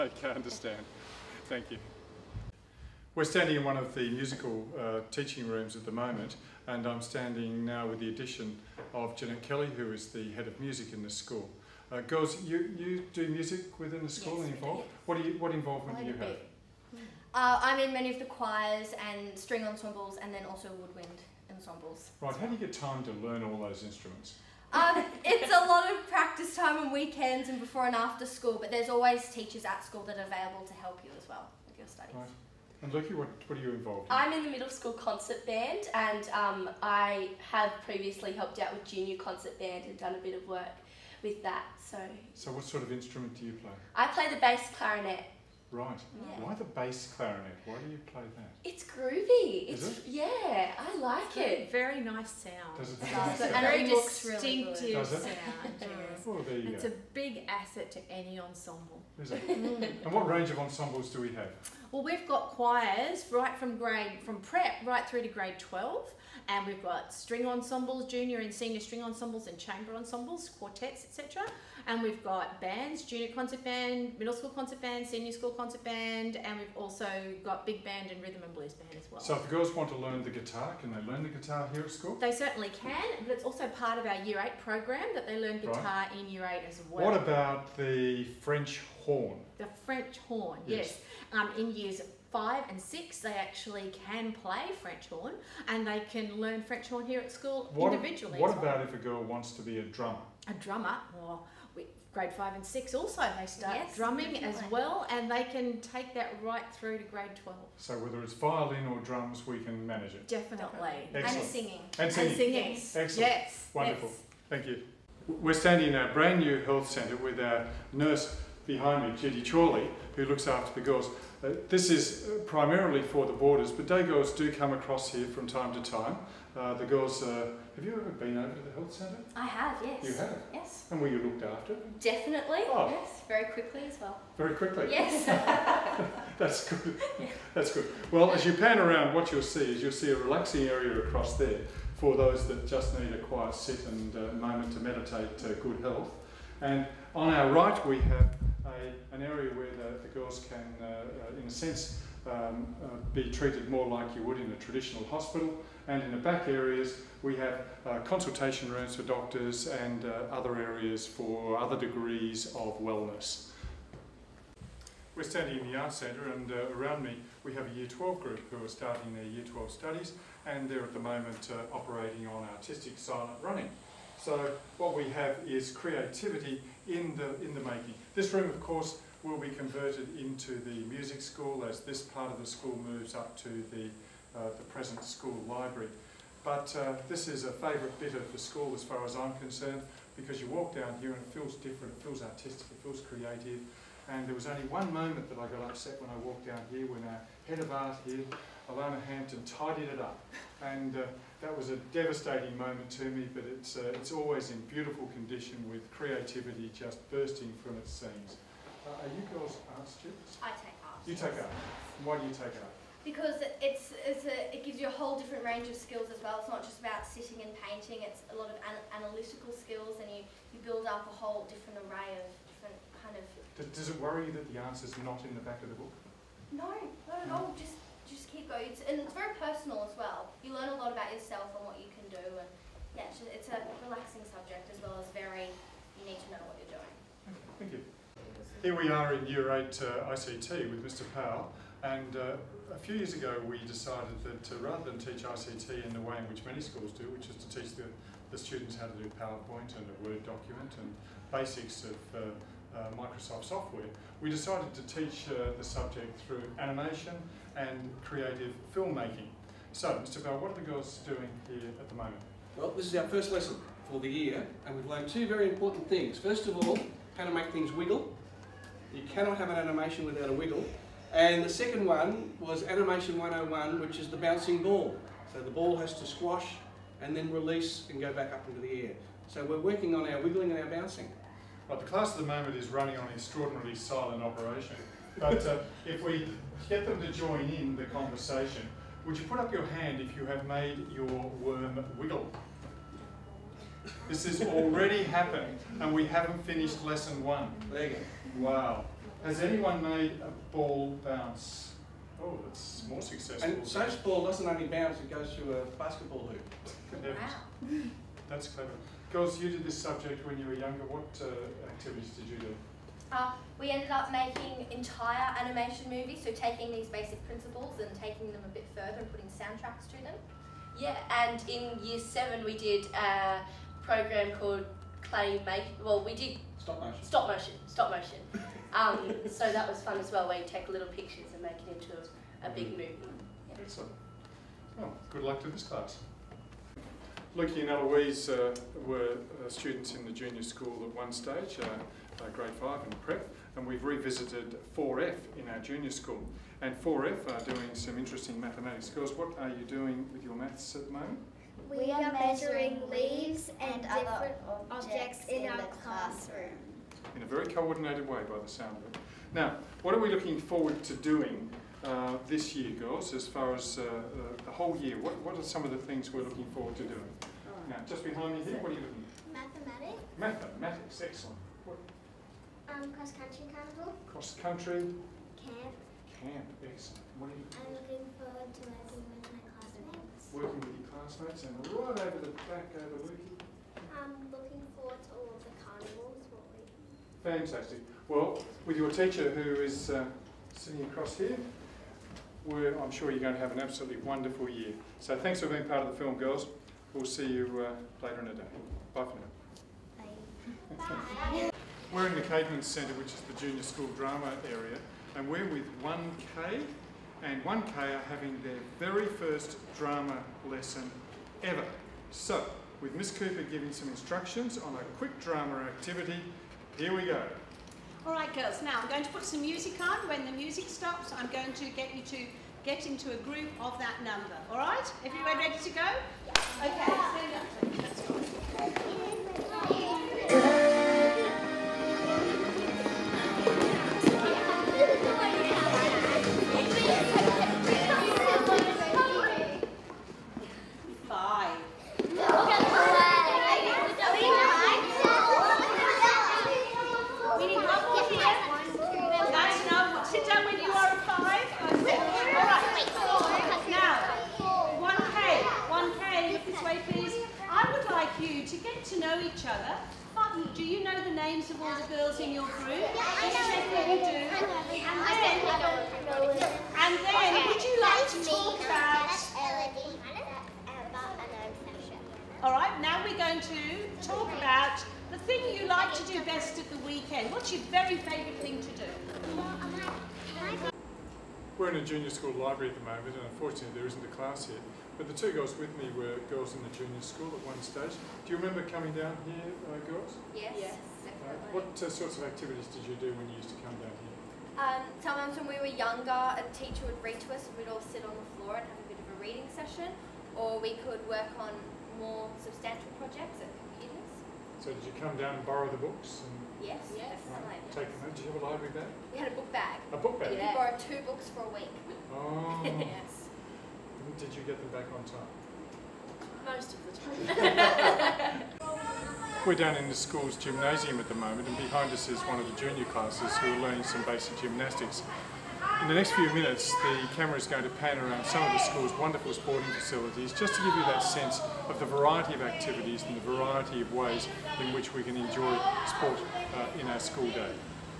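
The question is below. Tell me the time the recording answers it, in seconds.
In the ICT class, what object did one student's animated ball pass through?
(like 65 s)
305 s.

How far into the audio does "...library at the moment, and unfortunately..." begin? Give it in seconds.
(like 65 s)
482 s.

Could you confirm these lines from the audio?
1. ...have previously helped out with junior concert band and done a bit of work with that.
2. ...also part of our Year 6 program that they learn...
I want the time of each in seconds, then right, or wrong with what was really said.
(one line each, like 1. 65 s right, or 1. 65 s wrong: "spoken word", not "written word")
1. 37 s right
2. 83 s wrong: "8", not "6".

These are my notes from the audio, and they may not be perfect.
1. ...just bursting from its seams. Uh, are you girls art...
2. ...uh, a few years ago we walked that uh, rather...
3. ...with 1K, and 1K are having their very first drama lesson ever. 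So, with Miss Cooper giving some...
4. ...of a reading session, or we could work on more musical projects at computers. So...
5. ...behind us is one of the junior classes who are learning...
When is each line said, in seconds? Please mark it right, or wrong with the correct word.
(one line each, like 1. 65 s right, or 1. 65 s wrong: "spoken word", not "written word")
1. 206 s right
2. 242 s wrong: "decided", not "walked"
3. 405 s right
4. 498 s wrong: "substantial", not "musical"
5. 521 s right.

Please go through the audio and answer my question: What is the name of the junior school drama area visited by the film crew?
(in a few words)
Caveman Centre.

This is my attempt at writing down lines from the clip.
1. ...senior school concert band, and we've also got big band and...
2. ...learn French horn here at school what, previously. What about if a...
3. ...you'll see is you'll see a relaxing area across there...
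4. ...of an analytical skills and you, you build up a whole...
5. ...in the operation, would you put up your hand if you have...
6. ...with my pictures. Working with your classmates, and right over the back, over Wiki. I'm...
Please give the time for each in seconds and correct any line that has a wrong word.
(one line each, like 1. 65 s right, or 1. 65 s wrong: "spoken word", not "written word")
1. 75 s right
2. 96 s wrong: "individually", not "previously"
3. 139 s right
4. 218 s right
5. 287 s wrong: "conversation", not "operation"
6. 379 s wrong: "classmates", not "pictures".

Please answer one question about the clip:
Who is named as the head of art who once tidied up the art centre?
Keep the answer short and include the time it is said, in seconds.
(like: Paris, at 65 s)
Alona Hampton, at 198 s.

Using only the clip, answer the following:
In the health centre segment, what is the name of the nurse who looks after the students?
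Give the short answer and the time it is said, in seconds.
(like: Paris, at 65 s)
Judy Chorley, at 119 s.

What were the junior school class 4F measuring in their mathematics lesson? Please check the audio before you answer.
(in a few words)
Leaves.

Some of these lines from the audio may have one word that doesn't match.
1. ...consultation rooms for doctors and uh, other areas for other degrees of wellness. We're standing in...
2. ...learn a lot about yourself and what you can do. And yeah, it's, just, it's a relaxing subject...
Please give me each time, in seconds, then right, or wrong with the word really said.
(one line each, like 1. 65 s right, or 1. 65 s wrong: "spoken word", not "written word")
1. 157 s right
2. 230 s right.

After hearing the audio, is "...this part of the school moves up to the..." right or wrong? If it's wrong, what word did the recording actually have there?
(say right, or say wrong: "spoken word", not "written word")
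right.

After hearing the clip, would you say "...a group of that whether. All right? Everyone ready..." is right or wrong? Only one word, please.
wrong.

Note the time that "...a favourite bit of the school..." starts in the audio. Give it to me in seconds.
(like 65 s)
187 s.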